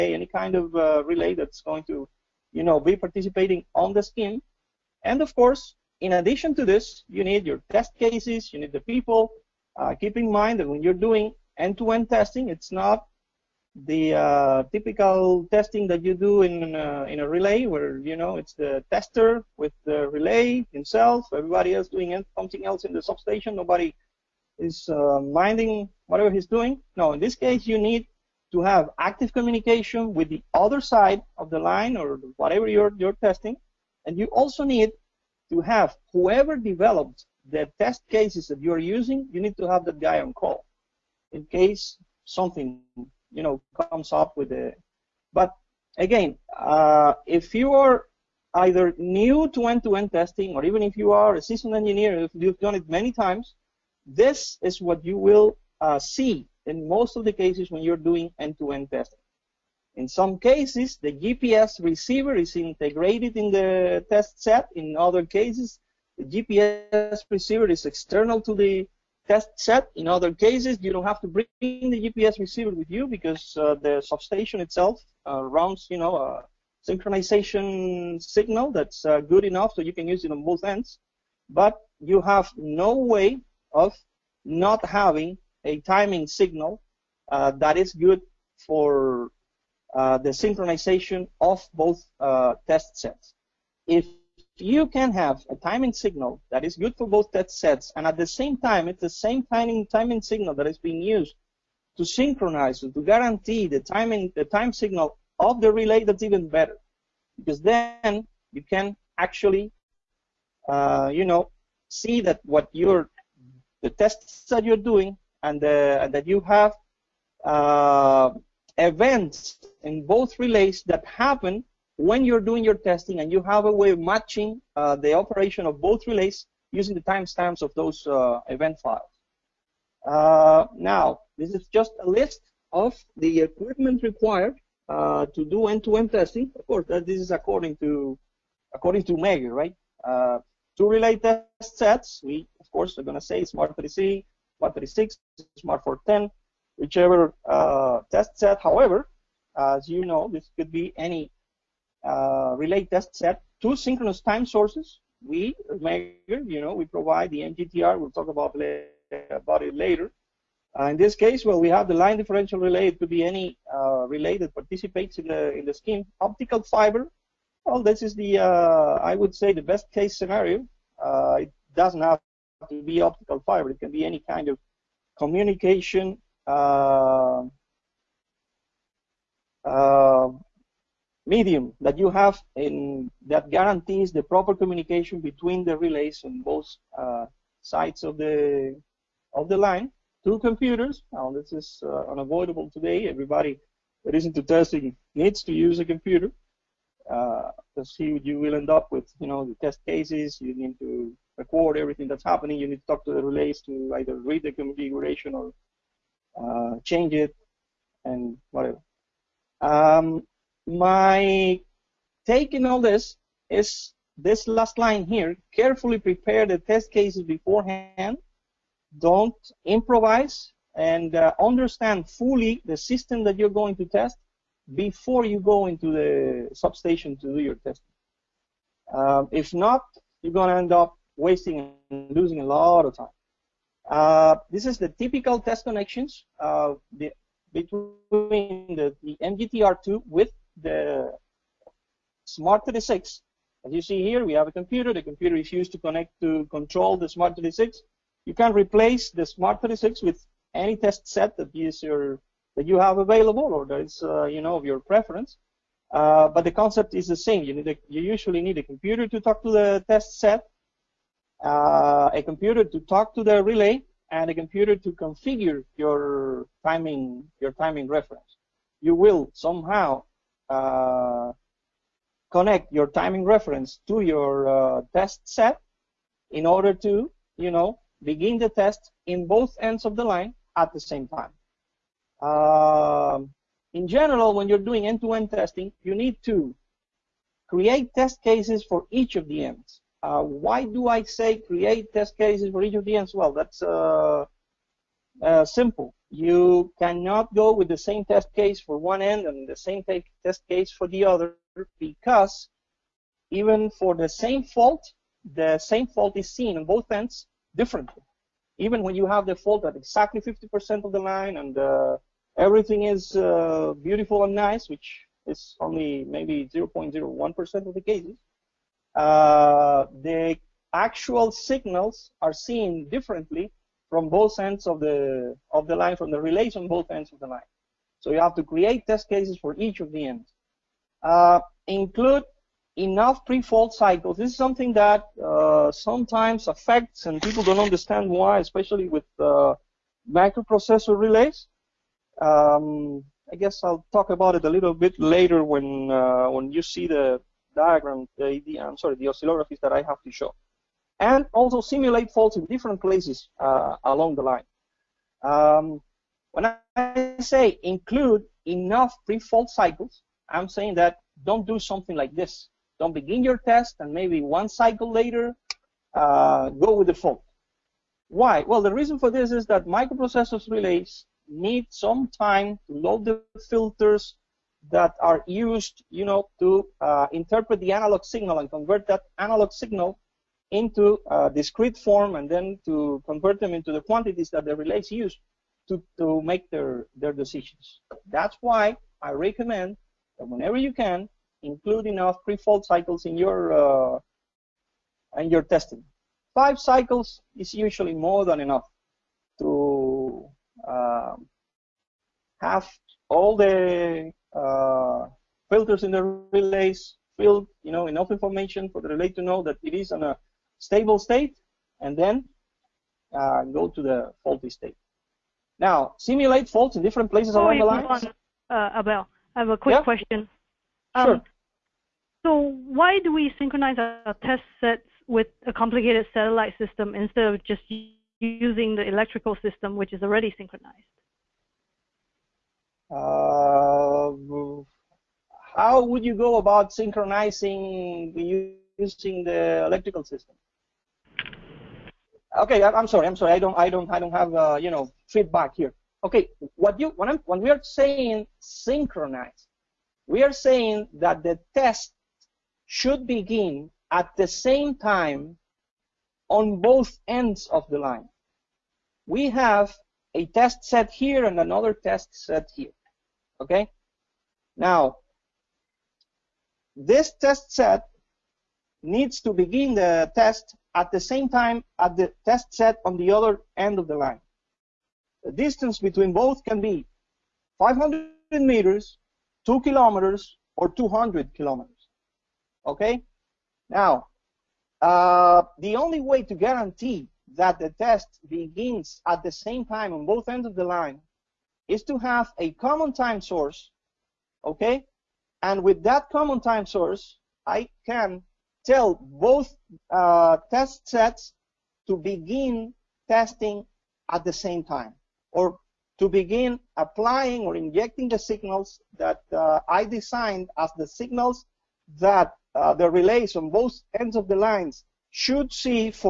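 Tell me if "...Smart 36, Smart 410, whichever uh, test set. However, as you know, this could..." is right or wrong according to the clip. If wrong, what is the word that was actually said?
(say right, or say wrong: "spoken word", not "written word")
right.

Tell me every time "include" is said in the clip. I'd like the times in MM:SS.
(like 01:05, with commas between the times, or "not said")
05:31, 05:57, 06:31.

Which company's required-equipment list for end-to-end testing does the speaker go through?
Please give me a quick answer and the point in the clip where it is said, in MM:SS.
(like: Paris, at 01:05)
Megger, at 02:19.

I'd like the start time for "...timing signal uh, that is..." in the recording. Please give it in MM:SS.
01:25.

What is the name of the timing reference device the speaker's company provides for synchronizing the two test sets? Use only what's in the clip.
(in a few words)
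MGTR.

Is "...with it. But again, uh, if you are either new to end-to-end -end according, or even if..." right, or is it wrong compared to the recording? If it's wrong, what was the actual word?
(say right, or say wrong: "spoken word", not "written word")
wrong: "testing", not "according".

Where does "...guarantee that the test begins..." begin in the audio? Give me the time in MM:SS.
08:06.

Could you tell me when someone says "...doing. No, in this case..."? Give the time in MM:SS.
00:26.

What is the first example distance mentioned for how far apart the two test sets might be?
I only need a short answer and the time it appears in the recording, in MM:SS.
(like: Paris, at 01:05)
500 meters, at 07:57.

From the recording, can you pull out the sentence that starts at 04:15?
Uh, but the concept is the same.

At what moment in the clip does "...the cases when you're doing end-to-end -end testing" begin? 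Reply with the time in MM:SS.
00:57.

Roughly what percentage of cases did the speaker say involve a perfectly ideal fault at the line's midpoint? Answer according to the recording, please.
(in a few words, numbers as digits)
0.01%.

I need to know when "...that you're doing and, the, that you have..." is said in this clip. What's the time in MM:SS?
01:54.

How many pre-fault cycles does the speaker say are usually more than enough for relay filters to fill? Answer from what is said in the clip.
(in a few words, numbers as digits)
5.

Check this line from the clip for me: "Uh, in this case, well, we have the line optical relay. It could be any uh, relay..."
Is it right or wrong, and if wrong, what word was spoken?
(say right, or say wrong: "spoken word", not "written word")
wrong: "differential", not "optical".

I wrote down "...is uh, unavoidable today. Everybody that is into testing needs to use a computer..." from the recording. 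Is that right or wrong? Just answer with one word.
right.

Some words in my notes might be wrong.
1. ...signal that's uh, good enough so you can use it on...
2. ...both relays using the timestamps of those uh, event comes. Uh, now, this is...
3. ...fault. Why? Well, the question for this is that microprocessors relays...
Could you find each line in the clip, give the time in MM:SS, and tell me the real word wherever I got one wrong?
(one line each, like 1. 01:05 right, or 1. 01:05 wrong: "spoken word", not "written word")
1. 01:18 right
2. 02:05 wrong: "files", not "comes"
3. 06:06 wrong: "reason", not "question".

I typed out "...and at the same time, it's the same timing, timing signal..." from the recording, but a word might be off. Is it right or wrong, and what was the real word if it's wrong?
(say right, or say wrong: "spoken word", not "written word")
right.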